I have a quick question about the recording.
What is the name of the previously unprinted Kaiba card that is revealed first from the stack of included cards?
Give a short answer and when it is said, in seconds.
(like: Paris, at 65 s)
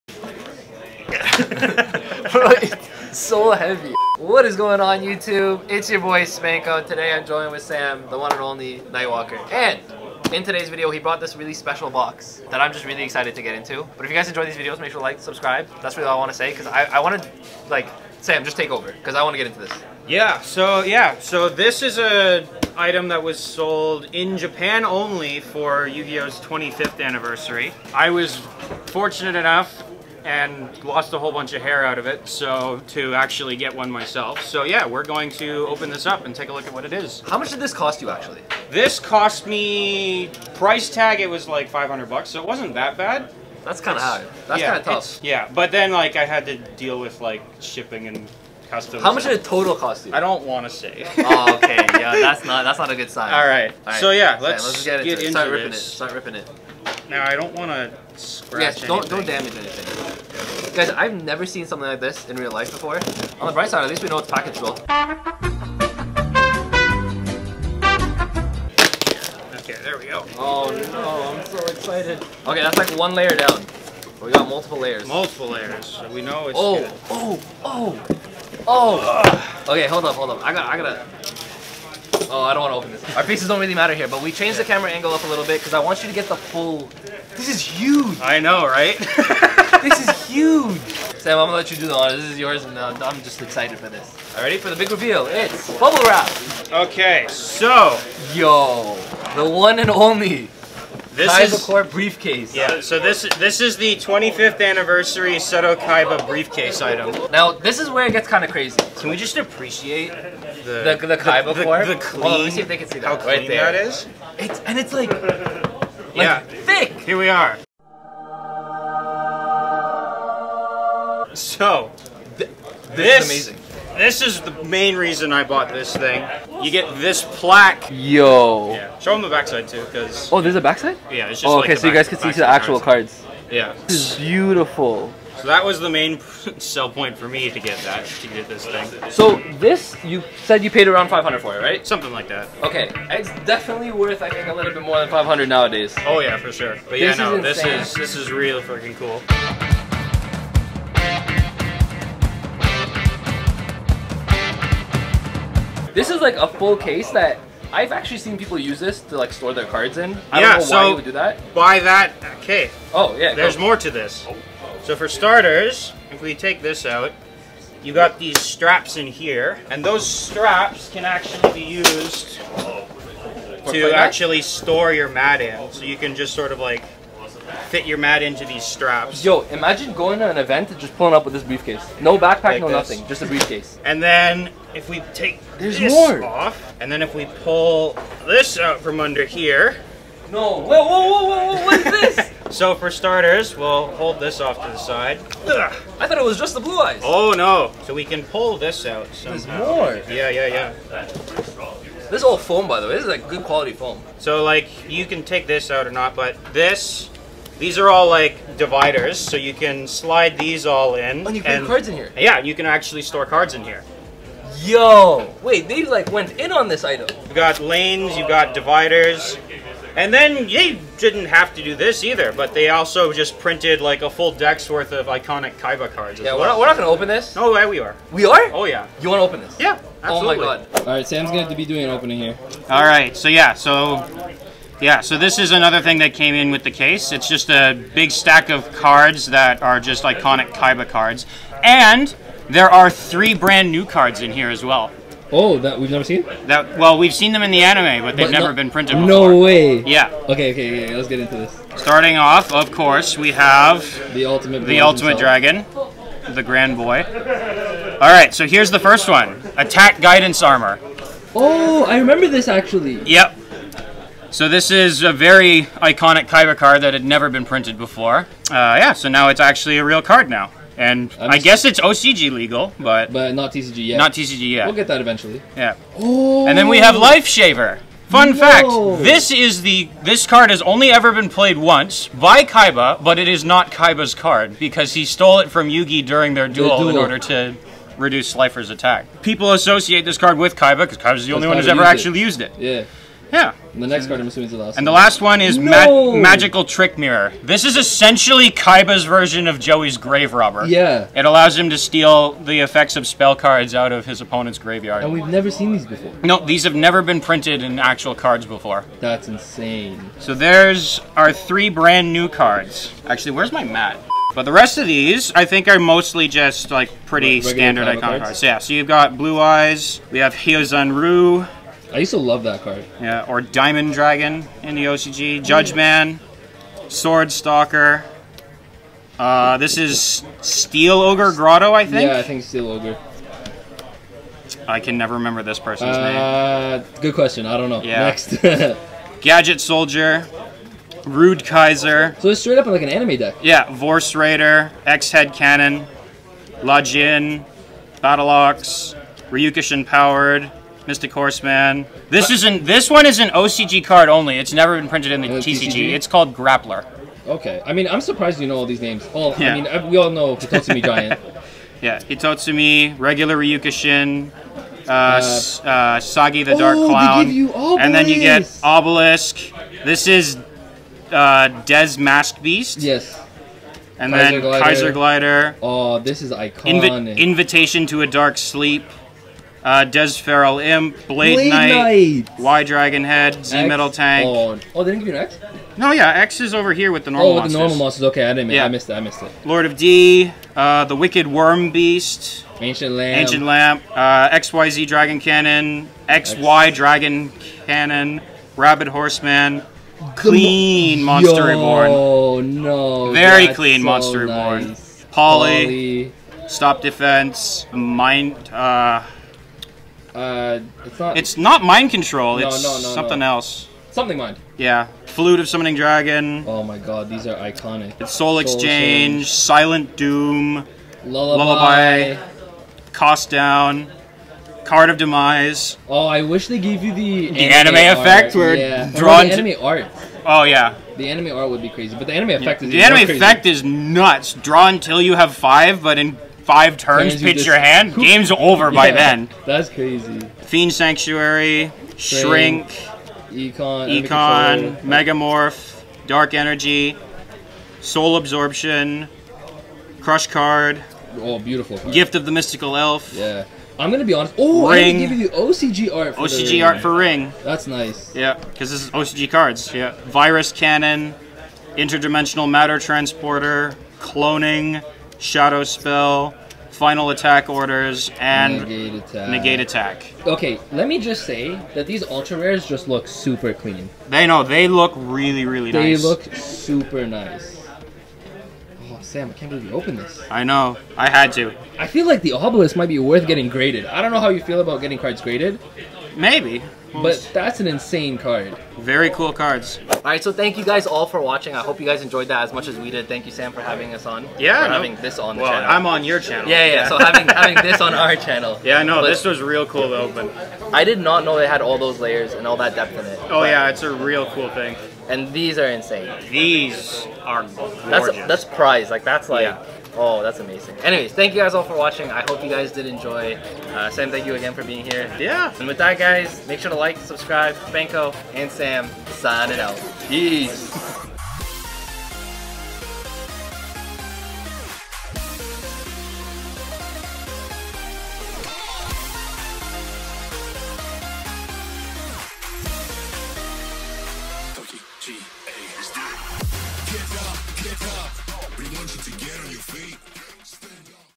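Attack Guidance Armor, at 259 s.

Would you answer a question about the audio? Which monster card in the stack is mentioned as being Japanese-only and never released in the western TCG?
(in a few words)
Grappler.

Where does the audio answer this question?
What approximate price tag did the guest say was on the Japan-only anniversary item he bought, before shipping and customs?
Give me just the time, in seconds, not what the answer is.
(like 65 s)
41 s.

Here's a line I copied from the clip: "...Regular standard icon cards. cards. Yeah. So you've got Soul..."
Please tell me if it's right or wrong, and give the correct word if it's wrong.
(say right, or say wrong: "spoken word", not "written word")
wrong: "Blue", not "Soul".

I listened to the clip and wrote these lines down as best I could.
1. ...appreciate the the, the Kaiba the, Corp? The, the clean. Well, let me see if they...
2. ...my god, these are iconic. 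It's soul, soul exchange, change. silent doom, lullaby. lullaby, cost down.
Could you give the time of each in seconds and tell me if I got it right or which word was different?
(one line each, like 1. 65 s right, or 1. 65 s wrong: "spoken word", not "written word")
1. 109 s right
2. 416 s right.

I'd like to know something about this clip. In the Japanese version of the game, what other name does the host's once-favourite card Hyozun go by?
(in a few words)
Diamond Dragon.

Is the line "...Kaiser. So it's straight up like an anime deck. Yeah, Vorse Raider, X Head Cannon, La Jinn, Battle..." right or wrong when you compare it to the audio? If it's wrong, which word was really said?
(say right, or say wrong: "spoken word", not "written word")
right.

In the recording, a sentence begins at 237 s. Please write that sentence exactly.
It's just a big stack of cards that are just iconic Kaiba cards.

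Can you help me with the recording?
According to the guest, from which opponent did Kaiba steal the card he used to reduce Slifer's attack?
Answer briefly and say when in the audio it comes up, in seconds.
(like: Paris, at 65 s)
Yugi, at 285 s.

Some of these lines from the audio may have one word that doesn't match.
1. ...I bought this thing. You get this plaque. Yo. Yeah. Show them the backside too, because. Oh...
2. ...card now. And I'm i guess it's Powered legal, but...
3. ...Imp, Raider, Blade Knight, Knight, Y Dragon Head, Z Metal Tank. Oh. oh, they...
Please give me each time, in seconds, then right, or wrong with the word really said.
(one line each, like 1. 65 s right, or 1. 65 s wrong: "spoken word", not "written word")
1. 125 s right
2. 270 s wrong: "OCG", not "Powered"
3. 380 s wrong: "Blade", not "Raider".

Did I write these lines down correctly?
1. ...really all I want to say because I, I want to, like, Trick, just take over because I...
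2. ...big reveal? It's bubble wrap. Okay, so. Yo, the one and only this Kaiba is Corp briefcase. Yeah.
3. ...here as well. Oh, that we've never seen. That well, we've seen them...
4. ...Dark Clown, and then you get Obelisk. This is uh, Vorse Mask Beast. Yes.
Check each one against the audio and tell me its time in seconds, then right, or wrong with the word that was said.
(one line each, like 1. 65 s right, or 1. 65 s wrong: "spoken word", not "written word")
1. 15 s wrong: "Sam", not "Trick"
2. 94 s right
3. 244 s right
4. 366 s wrong: "Des", not "Vorse".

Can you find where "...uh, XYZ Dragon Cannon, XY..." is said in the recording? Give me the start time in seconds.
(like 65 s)
393 s.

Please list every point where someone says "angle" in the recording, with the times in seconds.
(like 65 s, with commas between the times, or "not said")
84 s.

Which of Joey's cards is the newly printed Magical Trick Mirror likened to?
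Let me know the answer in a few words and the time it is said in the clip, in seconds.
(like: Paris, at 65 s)
Grave Robber, at 299 s.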